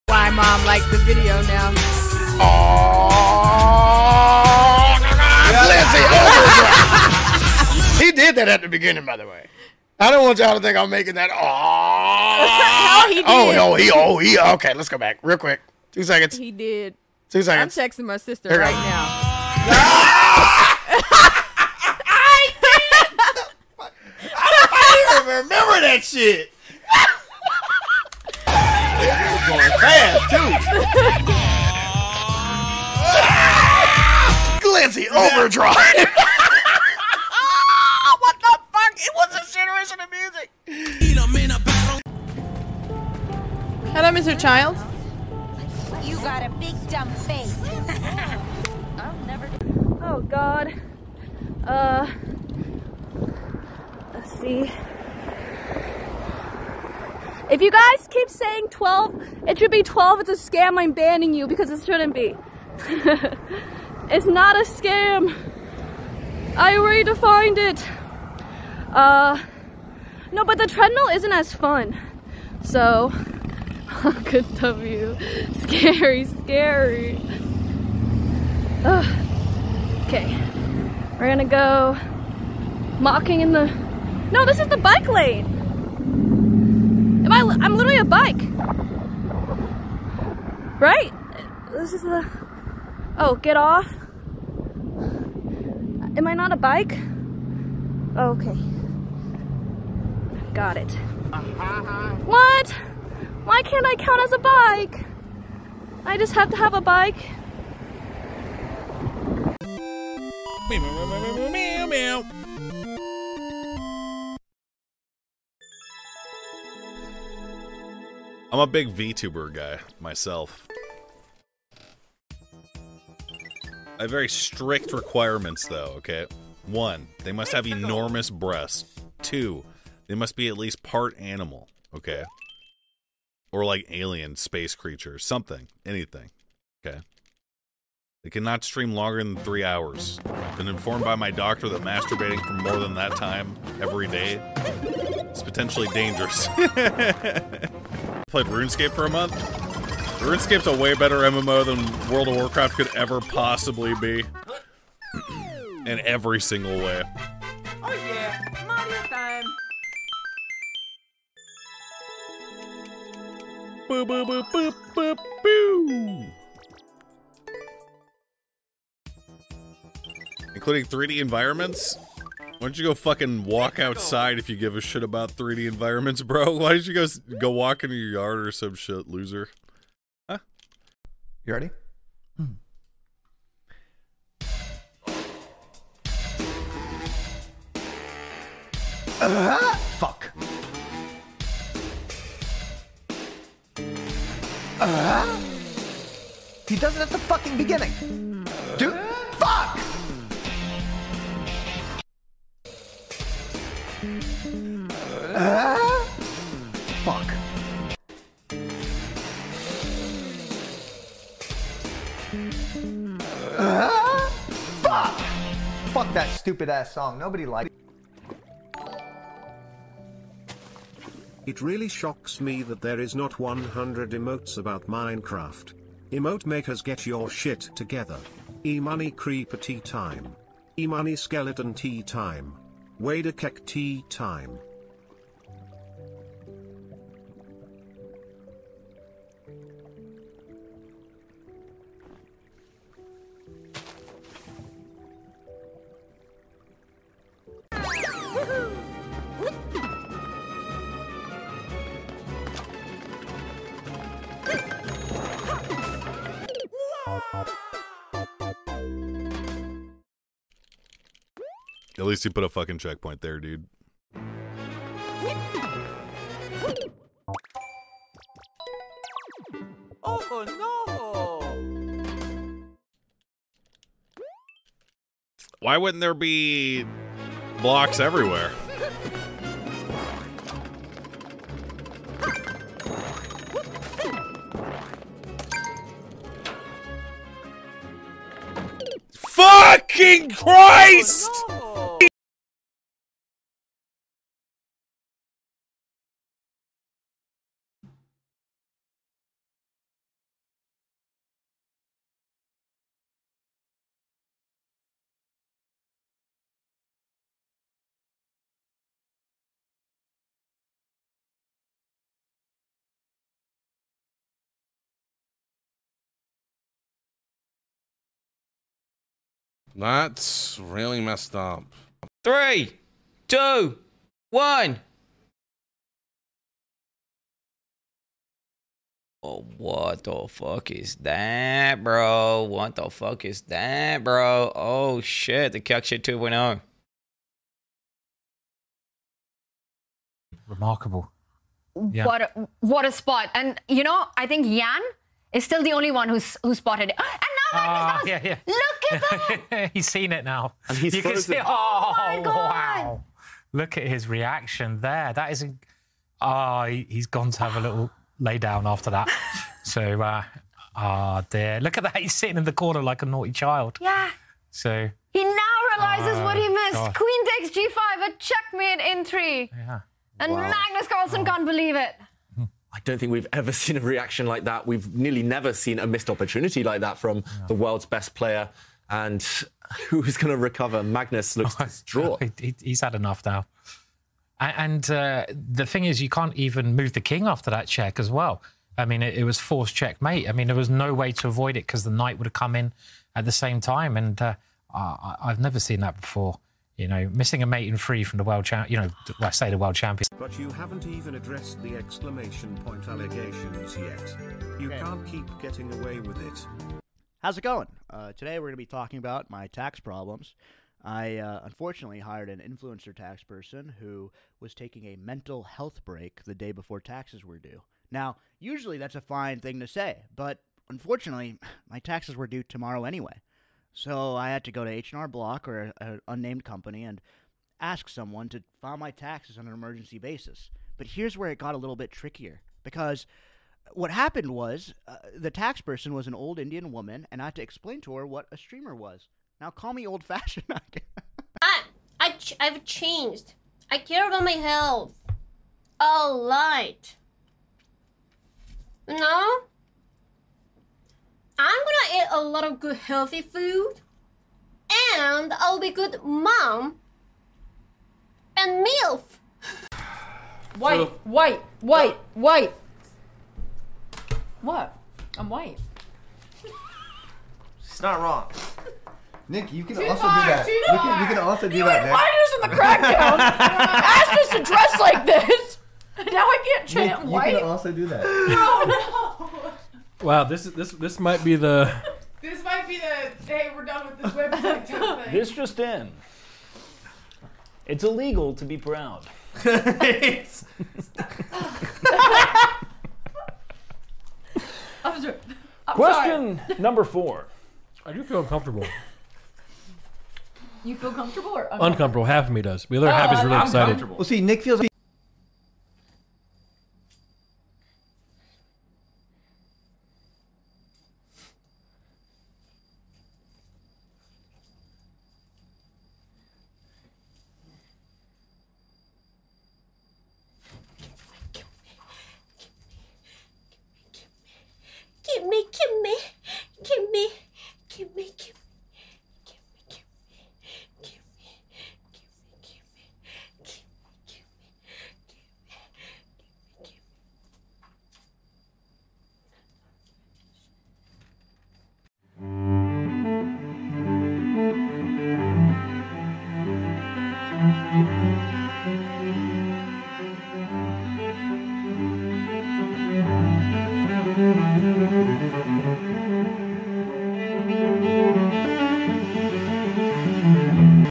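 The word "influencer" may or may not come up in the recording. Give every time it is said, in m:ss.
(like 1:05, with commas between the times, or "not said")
6:52.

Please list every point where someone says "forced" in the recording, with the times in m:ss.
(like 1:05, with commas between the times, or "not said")
6:29.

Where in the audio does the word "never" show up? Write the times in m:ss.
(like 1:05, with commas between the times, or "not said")
6:15, 6:35.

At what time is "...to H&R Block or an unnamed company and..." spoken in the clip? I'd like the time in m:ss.
7:04.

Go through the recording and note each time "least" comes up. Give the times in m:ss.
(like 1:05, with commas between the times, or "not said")
2:10, 4:22.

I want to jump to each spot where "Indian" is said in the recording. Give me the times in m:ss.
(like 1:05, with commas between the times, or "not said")
7:16.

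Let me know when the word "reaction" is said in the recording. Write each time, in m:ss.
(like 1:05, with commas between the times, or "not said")
5:54, 6:13.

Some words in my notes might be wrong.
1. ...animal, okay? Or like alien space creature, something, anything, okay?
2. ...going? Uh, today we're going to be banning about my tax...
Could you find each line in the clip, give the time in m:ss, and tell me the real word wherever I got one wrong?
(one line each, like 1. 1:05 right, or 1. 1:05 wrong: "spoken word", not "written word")
1. 2:11 right
2. 6:47 wrong: "talking", not "banning".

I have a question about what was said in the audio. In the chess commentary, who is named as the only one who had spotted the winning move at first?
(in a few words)
Yan.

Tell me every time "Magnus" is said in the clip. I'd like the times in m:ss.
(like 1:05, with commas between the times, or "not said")
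6:10, 6:20.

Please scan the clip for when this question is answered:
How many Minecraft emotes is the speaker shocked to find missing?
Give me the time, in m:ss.
3:43.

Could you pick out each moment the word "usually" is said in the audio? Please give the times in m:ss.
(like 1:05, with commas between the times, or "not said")
6:58.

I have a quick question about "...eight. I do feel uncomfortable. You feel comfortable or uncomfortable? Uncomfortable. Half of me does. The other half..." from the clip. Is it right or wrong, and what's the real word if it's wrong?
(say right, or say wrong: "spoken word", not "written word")
wrong: "four", not "eight".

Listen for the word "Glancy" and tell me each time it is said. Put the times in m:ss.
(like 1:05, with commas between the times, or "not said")
0:34.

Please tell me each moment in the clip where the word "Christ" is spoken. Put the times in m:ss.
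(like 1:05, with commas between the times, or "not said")
4:50.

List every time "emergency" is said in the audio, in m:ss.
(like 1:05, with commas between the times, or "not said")
7:09.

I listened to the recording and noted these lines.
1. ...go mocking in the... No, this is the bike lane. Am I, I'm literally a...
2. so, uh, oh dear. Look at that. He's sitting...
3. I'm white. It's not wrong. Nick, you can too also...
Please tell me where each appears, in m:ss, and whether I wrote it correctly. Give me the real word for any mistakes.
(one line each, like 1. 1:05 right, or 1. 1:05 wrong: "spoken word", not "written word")
1. 1:21 right
2. 5:59 right
3. 7:45 right.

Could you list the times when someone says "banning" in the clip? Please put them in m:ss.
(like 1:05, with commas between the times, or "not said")
1:00.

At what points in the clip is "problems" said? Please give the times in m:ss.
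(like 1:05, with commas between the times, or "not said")
6:49.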